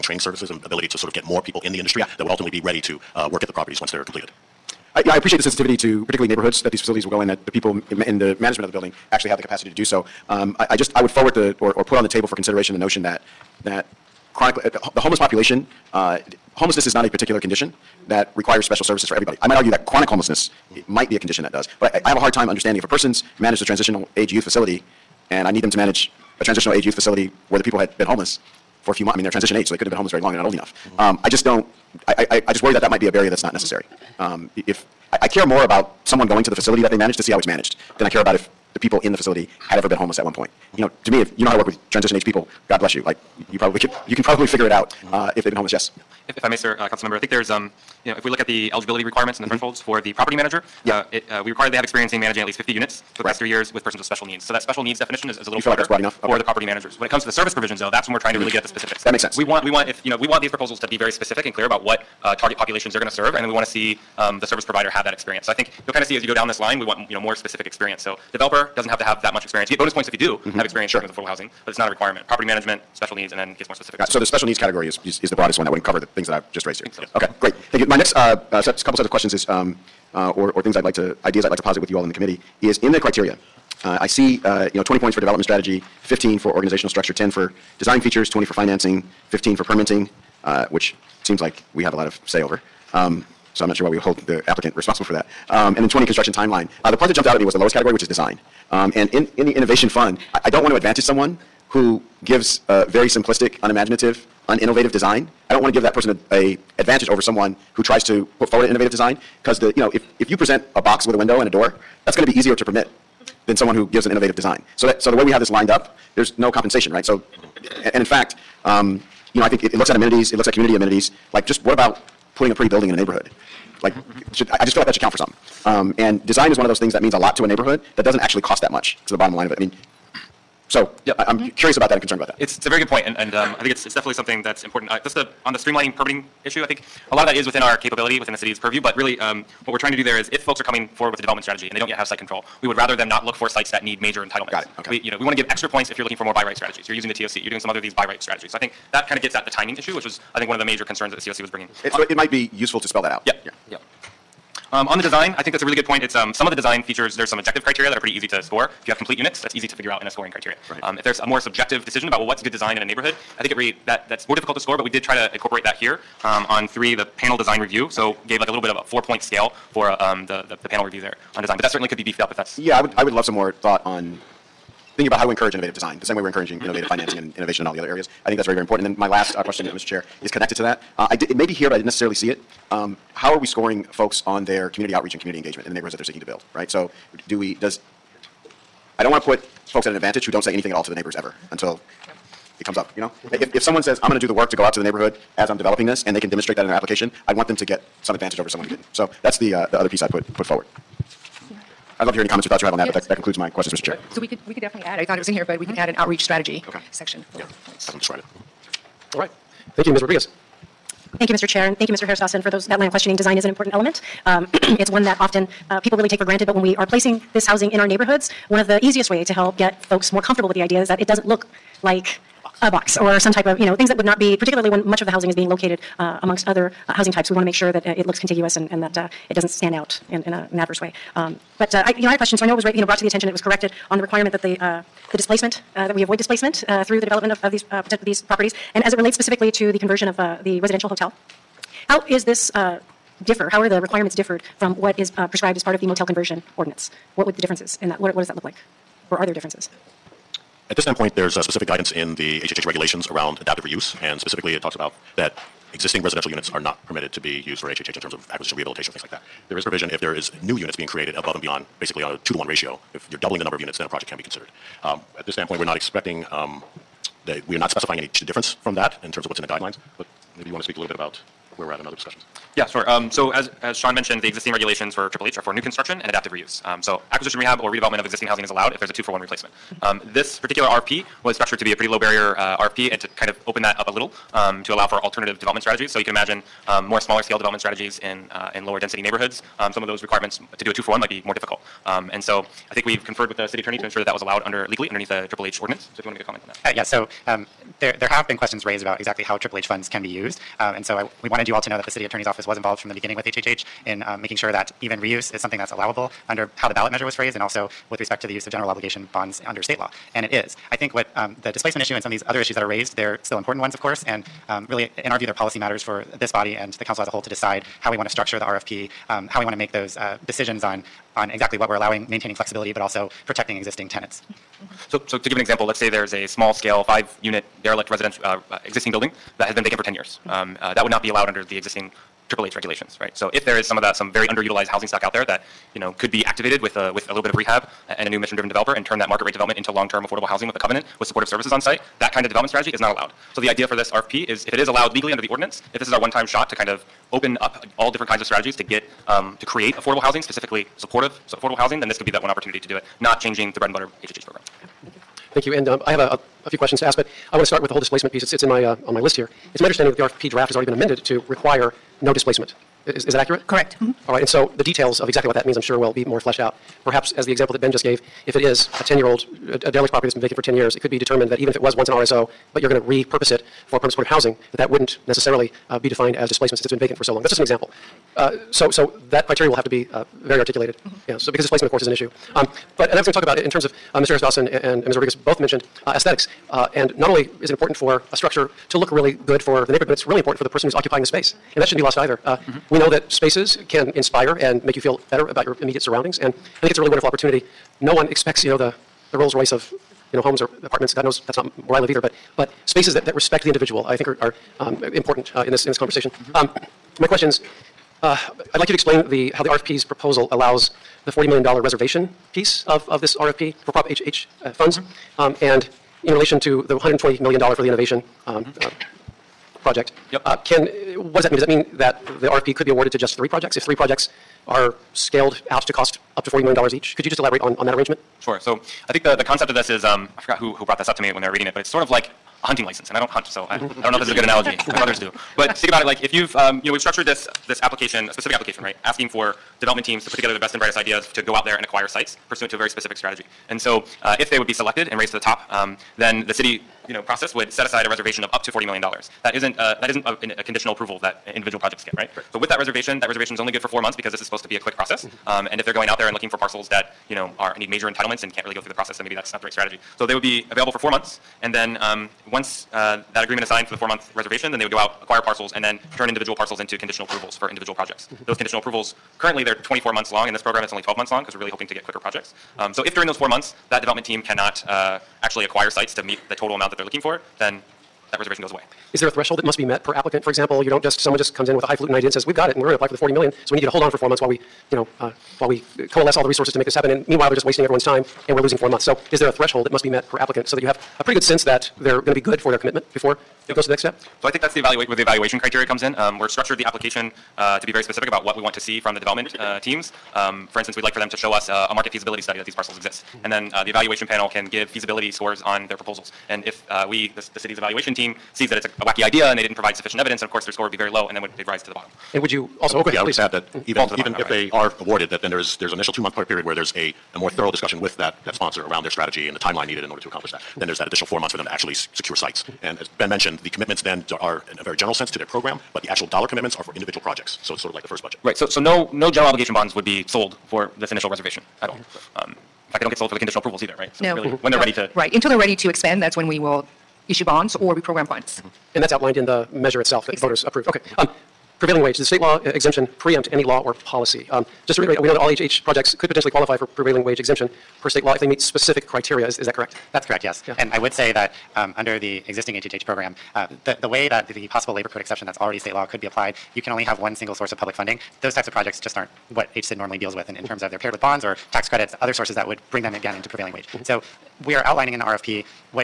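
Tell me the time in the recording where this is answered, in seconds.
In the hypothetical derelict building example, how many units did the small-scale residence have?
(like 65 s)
326 s.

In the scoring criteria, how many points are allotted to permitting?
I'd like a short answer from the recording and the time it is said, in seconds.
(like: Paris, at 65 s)
15, at 89 s.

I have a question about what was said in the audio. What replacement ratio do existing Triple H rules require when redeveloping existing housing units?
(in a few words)
2 to 1.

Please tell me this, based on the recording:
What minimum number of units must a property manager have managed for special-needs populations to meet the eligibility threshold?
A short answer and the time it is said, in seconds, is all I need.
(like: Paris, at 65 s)
50, at 52 s.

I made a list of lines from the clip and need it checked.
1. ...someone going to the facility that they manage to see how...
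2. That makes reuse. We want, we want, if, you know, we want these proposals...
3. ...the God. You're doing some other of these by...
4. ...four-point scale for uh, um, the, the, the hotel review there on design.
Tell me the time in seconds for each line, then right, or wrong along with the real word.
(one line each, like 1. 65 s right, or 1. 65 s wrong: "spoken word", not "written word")
1. 36 s right
2. 59 s wrong: "sense", not "reuse"
3. 147 s wrong: "TOC", not "God"
4. 168 s wrong: "panel", not "hotel".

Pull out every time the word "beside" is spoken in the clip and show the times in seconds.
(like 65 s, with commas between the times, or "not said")
not said.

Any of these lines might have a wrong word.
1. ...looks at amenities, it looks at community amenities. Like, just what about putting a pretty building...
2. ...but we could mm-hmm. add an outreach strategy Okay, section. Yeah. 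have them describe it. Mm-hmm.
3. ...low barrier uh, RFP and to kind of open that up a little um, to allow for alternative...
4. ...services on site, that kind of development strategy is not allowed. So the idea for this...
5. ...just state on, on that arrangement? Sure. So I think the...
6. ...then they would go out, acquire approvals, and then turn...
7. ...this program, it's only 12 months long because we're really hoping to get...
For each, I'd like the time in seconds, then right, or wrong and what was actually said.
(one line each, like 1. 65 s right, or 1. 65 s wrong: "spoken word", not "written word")
1. 119 s right
2. 205 s right
3. 281 s right
4. 341 s right
5. 427 s wrong: "elaborate", not "state"
6. 464 s wrong: "parcels", not "approvals"
7. 470 s right.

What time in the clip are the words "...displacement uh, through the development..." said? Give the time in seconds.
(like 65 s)
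236 s.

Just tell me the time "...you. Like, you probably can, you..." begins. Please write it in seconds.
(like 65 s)
42 s.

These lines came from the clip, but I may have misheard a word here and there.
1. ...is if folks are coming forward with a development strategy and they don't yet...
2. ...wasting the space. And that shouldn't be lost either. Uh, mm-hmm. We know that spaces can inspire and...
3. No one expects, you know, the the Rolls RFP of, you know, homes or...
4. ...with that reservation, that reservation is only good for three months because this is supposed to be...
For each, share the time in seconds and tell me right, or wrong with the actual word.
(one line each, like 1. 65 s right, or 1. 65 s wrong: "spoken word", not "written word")
1. 140 s right
2. 390 s wrong: "occupying", not "wasting"
3. 397 s wrong: "Royce", not "RFP"
4. 452 s wrong: "four", not "three".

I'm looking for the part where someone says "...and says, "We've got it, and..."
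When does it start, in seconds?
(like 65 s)
482 s.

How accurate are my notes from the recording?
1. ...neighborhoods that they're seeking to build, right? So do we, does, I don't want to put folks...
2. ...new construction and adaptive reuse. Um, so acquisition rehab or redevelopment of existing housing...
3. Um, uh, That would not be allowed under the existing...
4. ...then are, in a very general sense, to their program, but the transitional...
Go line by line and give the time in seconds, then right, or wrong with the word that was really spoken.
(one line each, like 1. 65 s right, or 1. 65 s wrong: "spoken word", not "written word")
1. 185 s right
2. 275 s right
3. 330 s right
4. 523 s wrong: "actual", not "transitional".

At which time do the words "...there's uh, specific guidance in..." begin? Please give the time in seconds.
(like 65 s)
251 s.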